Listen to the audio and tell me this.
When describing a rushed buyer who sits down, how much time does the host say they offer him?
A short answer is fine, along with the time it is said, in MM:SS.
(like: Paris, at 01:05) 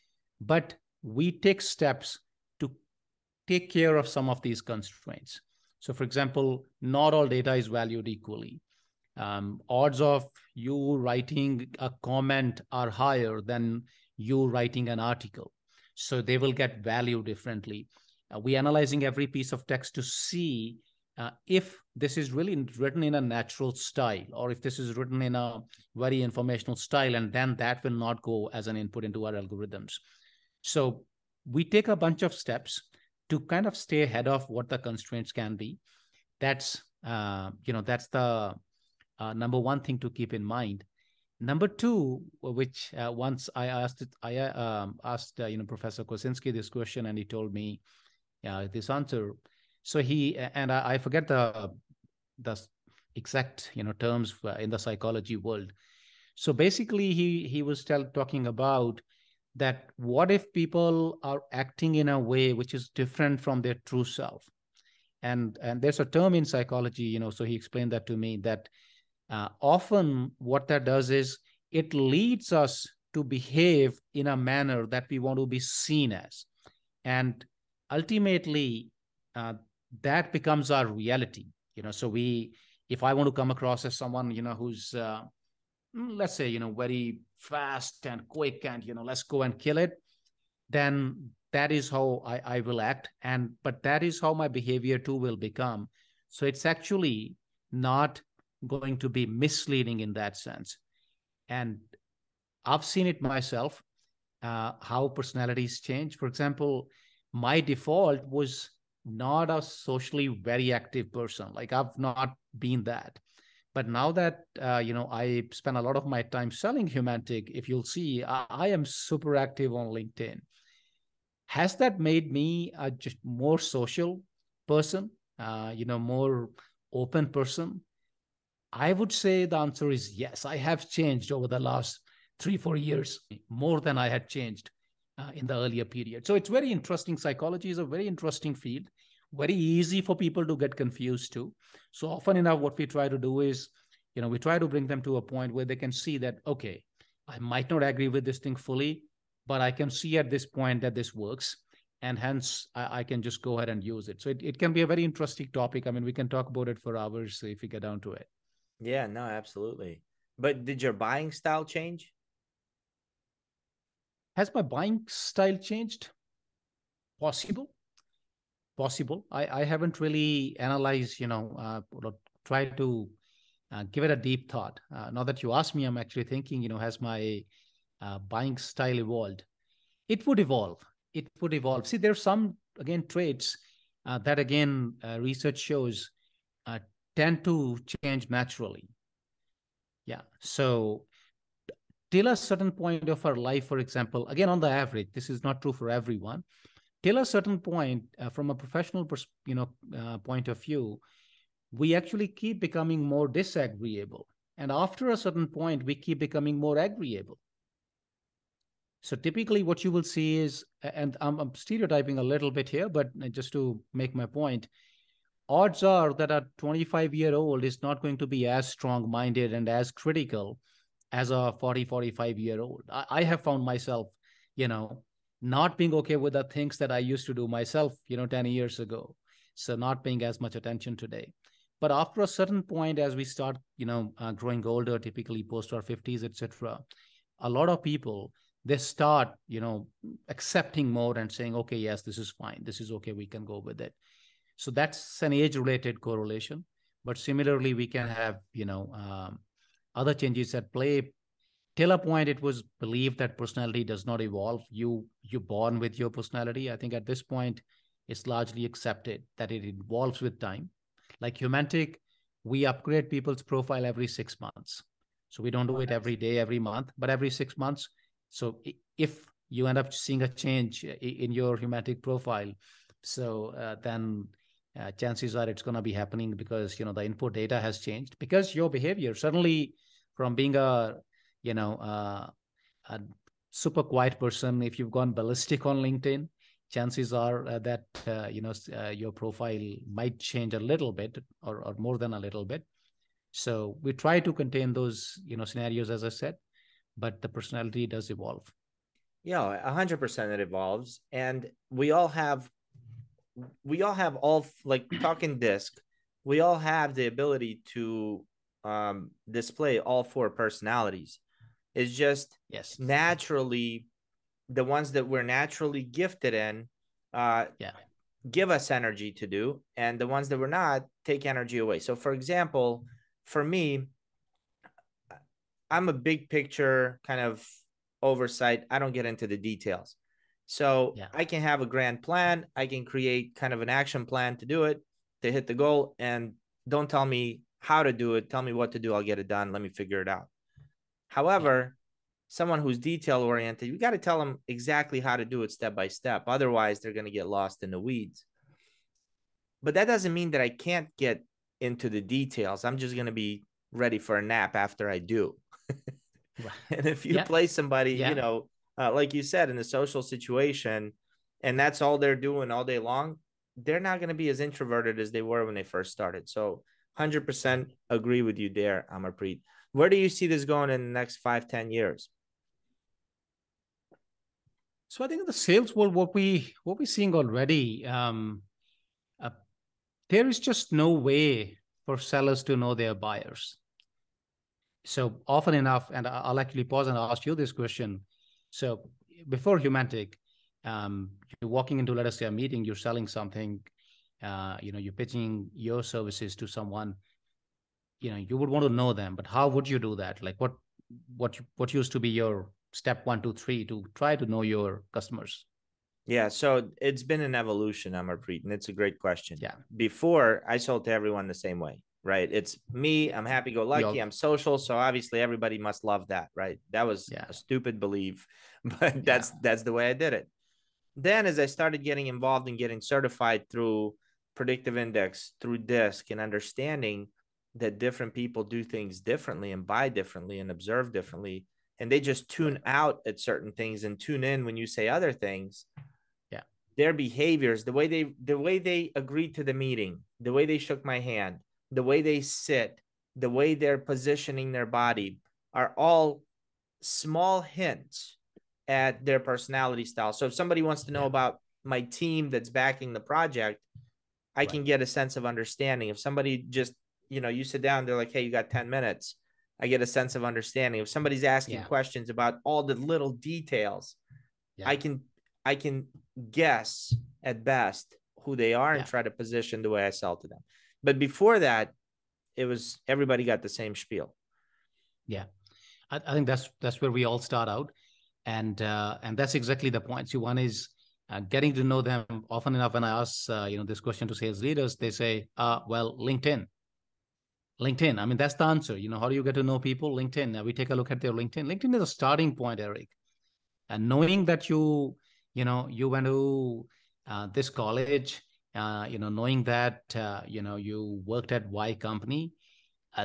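10 minutes, at 07:38.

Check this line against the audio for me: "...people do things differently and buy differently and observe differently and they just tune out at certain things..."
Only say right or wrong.
right.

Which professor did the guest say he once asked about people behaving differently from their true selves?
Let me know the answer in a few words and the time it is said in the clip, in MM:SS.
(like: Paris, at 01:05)
Professor Kosinski, at 00:45.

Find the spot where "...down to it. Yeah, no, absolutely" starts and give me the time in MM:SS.
02:37.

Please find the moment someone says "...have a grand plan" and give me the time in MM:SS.
05:31.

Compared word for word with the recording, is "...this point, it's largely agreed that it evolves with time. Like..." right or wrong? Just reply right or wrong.
wrong.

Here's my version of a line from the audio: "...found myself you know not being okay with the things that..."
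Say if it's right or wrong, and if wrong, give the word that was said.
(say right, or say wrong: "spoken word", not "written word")
right.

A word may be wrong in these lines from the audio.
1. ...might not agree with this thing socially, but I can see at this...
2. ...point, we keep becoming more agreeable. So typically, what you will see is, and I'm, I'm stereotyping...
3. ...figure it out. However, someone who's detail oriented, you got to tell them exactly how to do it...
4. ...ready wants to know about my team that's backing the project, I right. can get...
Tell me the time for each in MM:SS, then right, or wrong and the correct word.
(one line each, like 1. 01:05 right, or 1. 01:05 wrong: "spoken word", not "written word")
1. 02:27 wrong: "fully", not "socially"
2. 03:25 right
3. 05:39 right
4. 07:30 wrong: "somebody", not "ready".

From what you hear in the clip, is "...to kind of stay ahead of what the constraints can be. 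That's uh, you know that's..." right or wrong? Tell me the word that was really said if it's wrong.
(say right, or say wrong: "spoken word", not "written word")
right.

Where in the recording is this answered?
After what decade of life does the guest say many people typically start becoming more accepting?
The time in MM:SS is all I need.
03:55.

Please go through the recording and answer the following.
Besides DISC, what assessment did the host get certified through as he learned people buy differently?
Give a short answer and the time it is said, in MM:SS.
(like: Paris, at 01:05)
Predictive Index, at 07:04.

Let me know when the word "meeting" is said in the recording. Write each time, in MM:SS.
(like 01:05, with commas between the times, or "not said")
06:32, 07:19.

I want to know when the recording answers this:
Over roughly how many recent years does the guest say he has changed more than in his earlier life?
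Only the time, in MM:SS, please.
02:12.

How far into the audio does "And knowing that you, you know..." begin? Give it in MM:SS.
08:13.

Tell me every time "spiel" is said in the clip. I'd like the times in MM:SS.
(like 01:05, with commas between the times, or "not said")
07:53.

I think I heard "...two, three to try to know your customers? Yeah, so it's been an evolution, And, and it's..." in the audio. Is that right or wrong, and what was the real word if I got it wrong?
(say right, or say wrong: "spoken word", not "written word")
wrong: "Amarpreet", not "And".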